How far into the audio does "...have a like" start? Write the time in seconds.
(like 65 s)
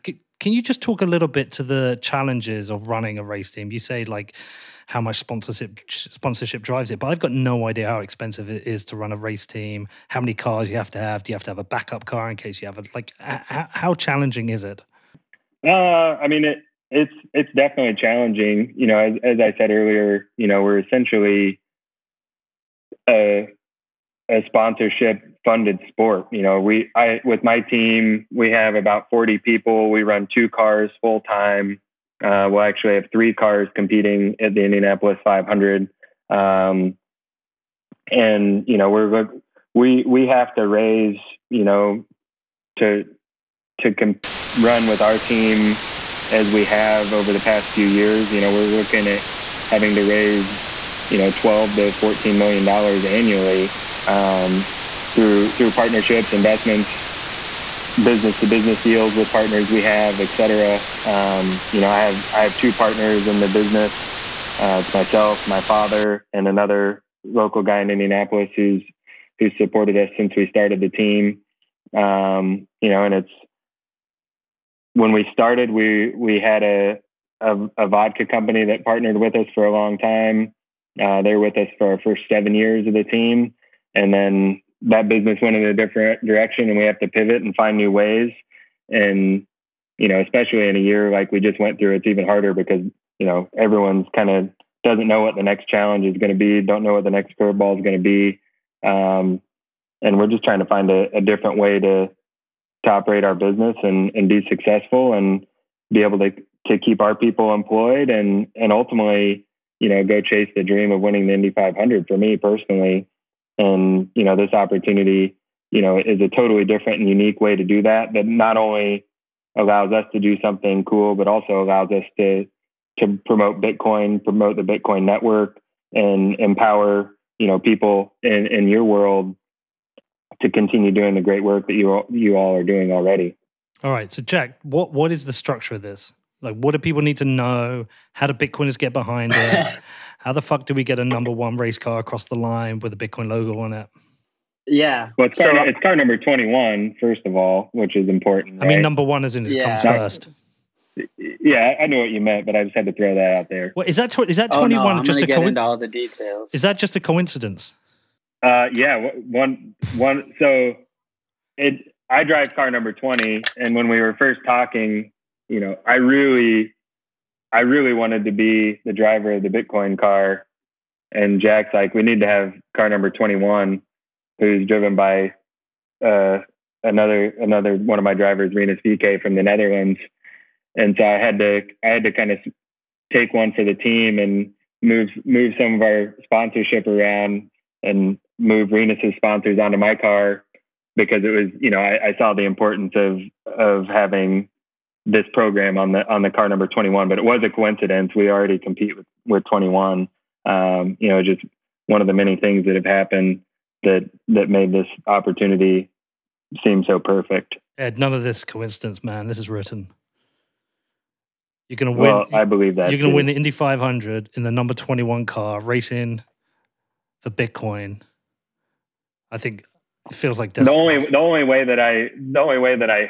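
12 s.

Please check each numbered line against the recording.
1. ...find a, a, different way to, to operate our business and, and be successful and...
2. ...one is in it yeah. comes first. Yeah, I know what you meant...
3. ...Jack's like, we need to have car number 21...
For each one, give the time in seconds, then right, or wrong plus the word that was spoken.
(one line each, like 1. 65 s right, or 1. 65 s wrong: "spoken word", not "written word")
1. 100 s right
2. 149 s right
3. 171 s right.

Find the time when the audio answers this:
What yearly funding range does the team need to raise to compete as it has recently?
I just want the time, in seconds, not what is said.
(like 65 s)
51 s.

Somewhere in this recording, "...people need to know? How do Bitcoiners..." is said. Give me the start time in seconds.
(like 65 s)
136 s.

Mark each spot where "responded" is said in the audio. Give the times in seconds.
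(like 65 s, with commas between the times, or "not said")
not said.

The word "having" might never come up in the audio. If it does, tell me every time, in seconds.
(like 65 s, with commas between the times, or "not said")
49 s, 193 s.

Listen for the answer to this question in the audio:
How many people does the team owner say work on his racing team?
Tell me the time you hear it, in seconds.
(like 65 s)
28 s.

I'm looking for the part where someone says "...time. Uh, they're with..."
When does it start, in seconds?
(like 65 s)
79 s.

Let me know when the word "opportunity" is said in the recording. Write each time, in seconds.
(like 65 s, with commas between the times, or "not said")
114 s, 205 s.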